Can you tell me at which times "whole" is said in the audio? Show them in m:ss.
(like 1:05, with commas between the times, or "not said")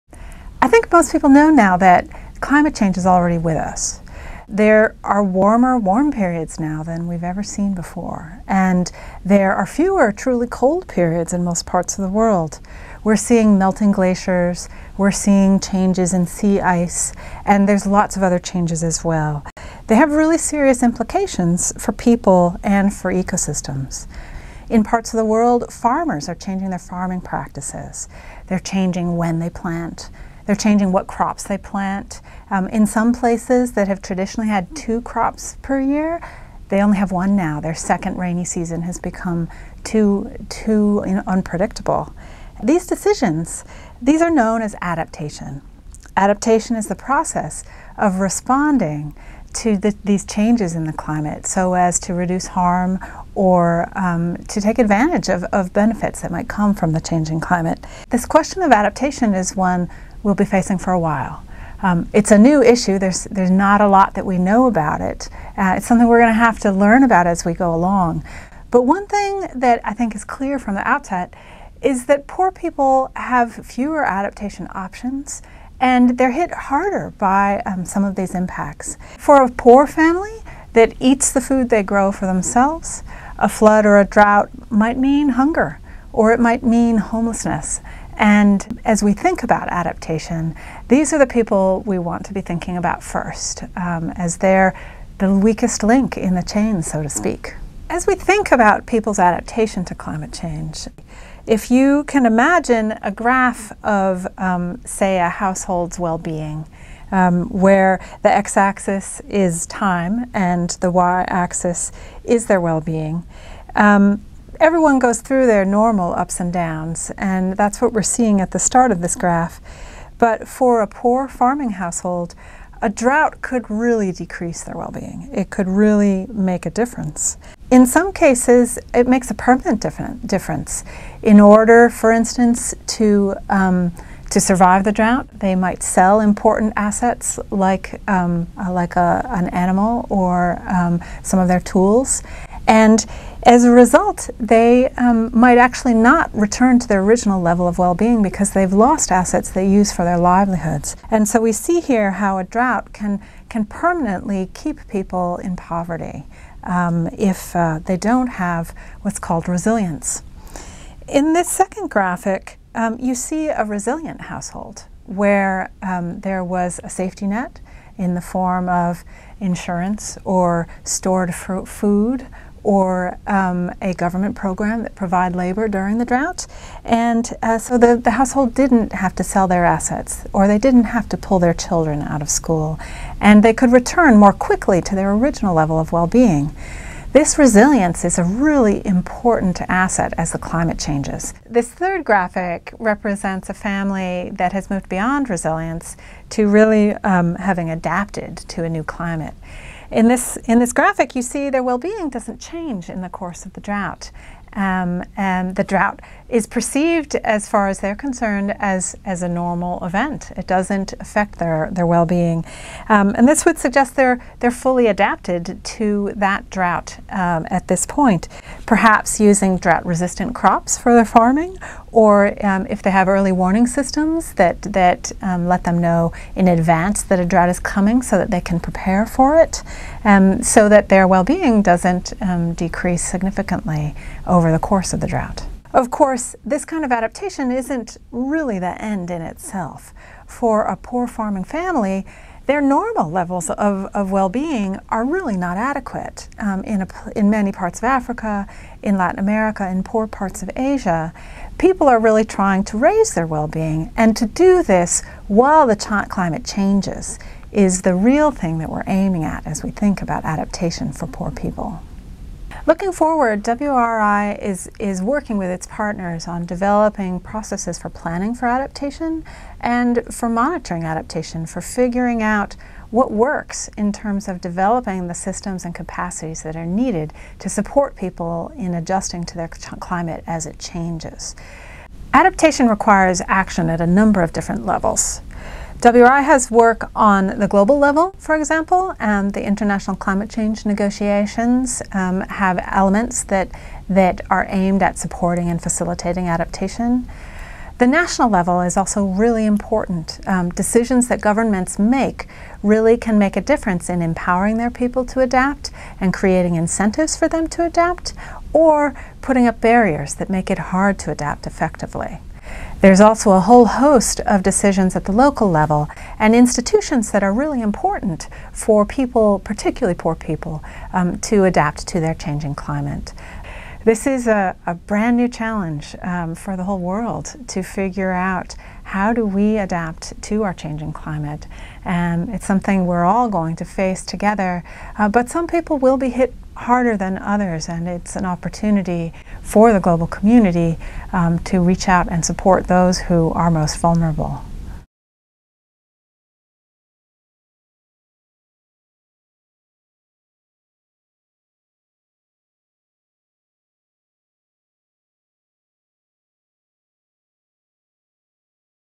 5:13, 5:26.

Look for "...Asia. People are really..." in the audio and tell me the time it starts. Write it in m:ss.
4:10.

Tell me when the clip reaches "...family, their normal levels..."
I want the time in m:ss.
4:01.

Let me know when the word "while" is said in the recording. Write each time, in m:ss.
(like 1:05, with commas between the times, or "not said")
1:00, 4:15.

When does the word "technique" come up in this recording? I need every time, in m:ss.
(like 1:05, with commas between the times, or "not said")
not said.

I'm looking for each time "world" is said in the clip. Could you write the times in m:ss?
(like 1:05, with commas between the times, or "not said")
0:12, 0:25, 5:26.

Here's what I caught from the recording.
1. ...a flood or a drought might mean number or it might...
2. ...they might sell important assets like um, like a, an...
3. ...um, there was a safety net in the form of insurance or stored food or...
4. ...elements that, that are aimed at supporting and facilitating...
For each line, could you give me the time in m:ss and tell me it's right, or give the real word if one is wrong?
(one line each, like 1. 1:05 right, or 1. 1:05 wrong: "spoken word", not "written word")
1. 1:23 wrong: "hunger", not "number"
2. 2:15 right
3. 2:45 right
4. 4:52 right.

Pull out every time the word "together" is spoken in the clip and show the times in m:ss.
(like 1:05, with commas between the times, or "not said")
5:34.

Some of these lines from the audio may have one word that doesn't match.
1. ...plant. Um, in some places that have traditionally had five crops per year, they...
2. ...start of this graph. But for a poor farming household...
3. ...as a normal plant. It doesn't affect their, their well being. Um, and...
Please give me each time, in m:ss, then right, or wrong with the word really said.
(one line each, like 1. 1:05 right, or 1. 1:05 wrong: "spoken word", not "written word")
1. 0:31 wrong: "two", not "five"
2. 1:58 right
3. 3:29 wrong: "event", not "plant".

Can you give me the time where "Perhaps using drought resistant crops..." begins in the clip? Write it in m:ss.
3:38.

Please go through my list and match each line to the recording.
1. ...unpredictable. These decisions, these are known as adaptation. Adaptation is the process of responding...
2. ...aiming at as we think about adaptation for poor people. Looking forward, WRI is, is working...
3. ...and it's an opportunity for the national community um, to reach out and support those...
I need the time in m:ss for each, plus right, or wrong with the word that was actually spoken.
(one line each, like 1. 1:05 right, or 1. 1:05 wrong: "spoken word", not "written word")
1. 0:41 right
2. 4:18 right
3. 5:37 wrong: "global", not "national".